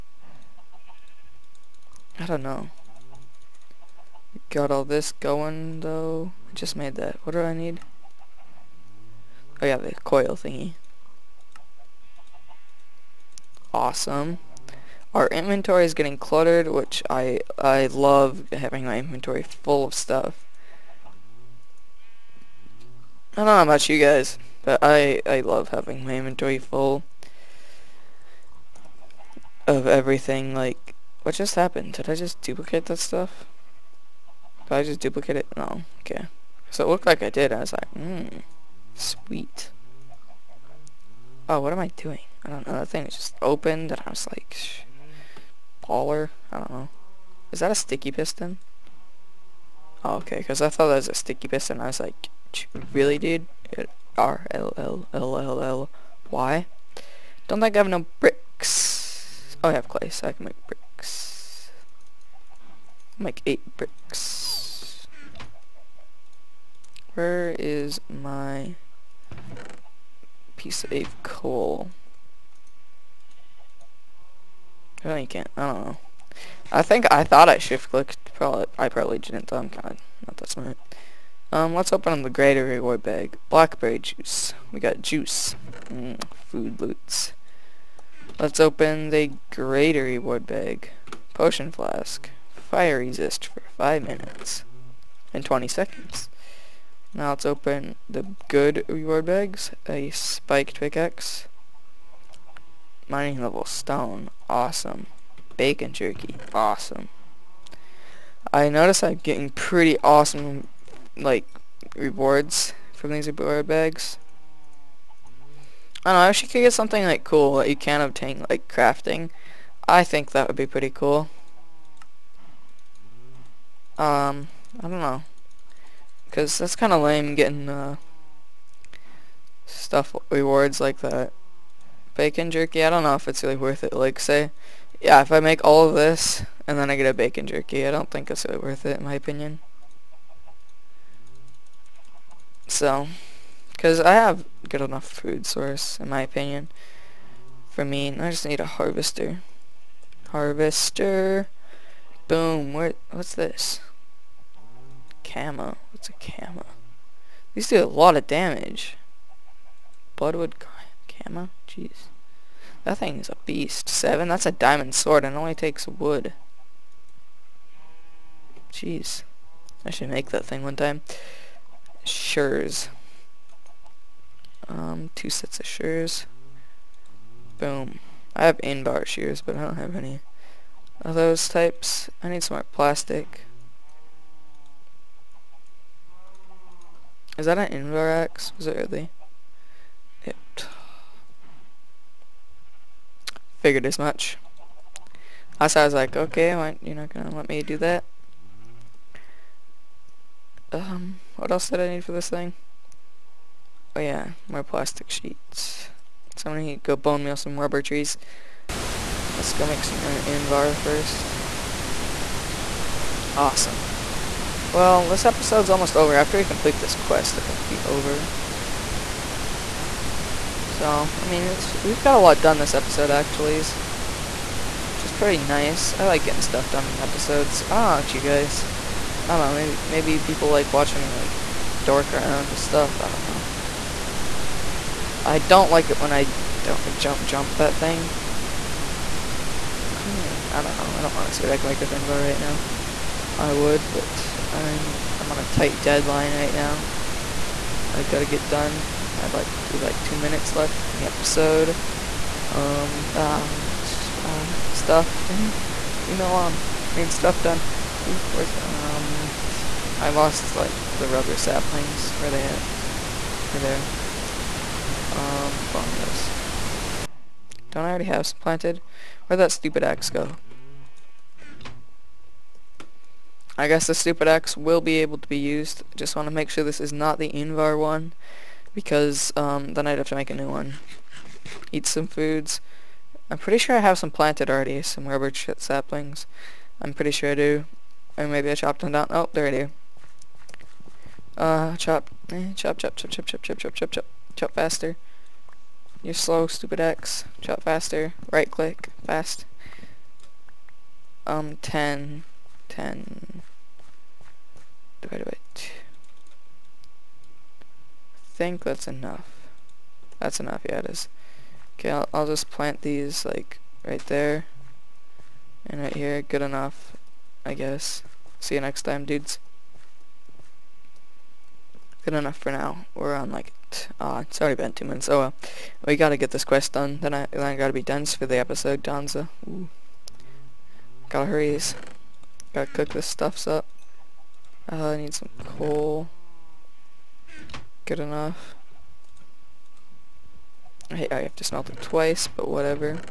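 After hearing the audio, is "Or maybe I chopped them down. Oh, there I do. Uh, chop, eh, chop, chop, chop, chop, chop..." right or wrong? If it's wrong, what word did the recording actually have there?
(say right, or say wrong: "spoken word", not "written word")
right.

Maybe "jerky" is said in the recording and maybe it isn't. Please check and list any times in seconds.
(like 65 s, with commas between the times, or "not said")
105 s, 132 s, 137 s.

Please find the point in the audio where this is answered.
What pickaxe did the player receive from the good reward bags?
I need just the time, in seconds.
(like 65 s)
100 s.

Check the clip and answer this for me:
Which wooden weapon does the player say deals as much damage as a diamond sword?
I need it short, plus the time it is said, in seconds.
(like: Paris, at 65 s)
Bloodwood camo, at 160 s.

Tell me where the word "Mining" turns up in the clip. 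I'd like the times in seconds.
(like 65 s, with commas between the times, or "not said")
103 s.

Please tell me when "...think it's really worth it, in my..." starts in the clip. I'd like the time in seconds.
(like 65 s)
138 s.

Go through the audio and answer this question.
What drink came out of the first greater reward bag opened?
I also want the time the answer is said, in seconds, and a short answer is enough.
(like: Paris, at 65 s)
Blackberry juice, at 83 s.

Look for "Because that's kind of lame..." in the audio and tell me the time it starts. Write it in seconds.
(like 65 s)
126 s.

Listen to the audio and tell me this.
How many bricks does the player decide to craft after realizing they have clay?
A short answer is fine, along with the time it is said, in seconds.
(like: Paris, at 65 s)
8, at 63 s.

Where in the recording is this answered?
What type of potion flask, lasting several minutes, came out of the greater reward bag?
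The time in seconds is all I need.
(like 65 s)
92 s.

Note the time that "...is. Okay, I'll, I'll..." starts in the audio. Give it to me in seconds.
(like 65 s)
310 s.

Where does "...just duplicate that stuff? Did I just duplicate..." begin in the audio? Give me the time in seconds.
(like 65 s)
32 s.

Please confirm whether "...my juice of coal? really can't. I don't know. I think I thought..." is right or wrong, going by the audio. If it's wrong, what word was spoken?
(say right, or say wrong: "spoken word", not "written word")
wrong: "piece", not "juice".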